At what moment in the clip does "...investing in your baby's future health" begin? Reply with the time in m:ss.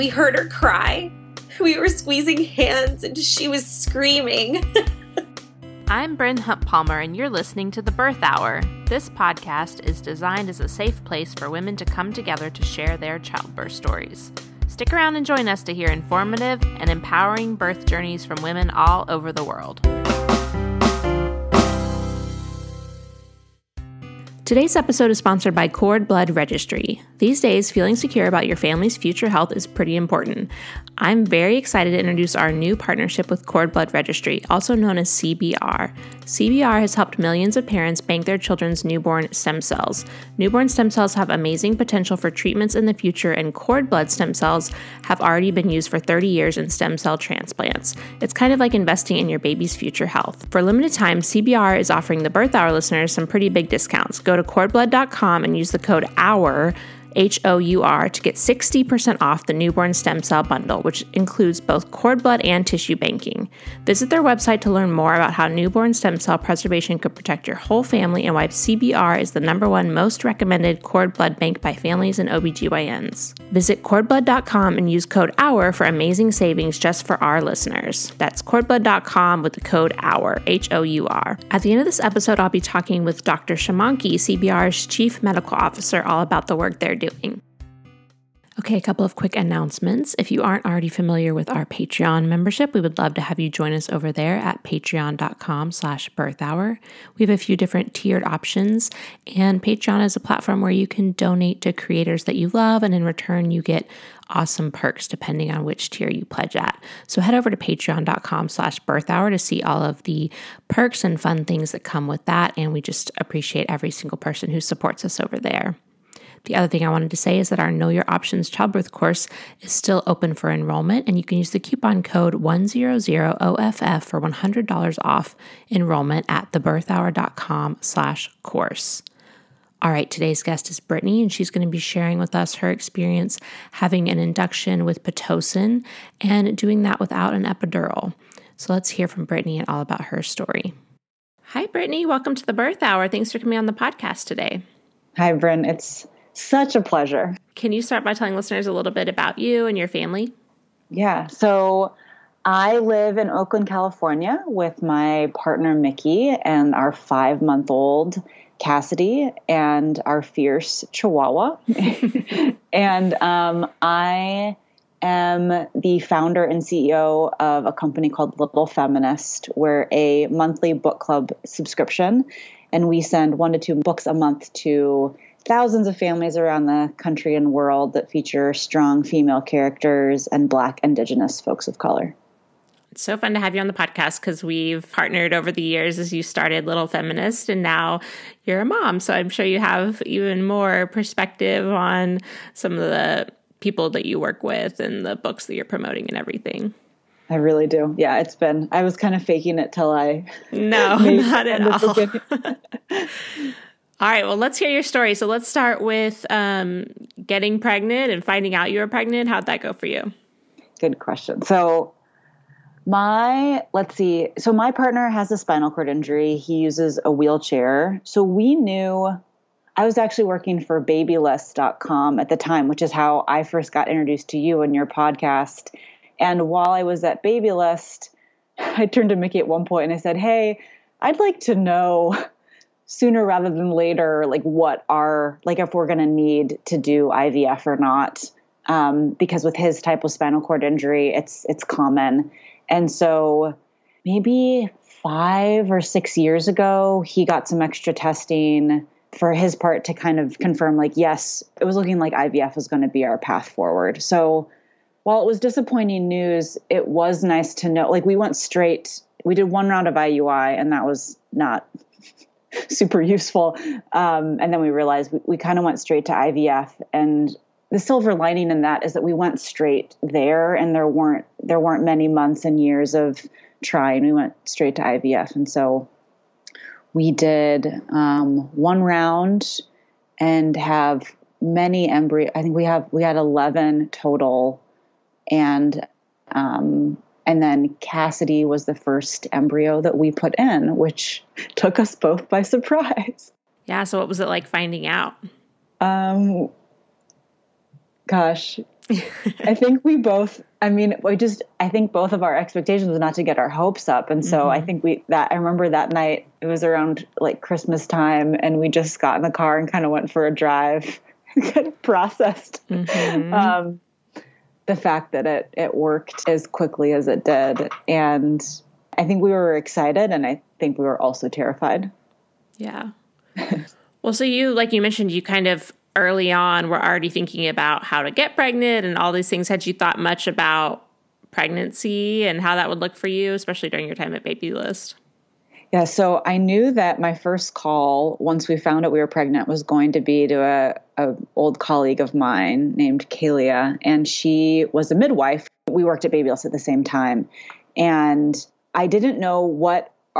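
0:48.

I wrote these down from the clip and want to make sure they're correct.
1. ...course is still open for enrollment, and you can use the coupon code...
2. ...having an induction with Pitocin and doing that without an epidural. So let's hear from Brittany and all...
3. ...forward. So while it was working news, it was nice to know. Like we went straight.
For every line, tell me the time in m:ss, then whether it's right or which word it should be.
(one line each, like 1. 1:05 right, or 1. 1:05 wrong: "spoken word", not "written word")
1. 1:58 right
2. 2:13 right
3. 4:13 wrong: "disappointing", not "working".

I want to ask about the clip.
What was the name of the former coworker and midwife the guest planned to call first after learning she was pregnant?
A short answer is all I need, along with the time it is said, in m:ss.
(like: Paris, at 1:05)
Kalia, at 5:43.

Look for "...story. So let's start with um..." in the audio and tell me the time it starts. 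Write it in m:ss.
3:24.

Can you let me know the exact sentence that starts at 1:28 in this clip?
Okay, a couple of quick announcements.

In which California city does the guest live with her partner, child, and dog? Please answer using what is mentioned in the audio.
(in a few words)
Oakland.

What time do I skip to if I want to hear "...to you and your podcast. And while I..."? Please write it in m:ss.
3:44.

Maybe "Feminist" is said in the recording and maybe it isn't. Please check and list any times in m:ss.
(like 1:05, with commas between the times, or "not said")
2:48, 3:06.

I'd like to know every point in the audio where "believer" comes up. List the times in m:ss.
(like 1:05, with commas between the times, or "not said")
not said.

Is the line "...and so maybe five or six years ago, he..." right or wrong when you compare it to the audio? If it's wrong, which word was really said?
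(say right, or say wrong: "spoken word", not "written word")
right.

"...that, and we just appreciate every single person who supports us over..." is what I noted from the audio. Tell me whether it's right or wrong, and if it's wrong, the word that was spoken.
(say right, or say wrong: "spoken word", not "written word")
right.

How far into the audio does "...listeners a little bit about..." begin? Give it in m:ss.
2:28.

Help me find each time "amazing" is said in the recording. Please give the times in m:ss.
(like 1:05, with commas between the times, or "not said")
0:41, 1:15.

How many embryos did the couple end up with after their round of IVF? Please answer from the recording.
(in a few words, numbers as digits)
11.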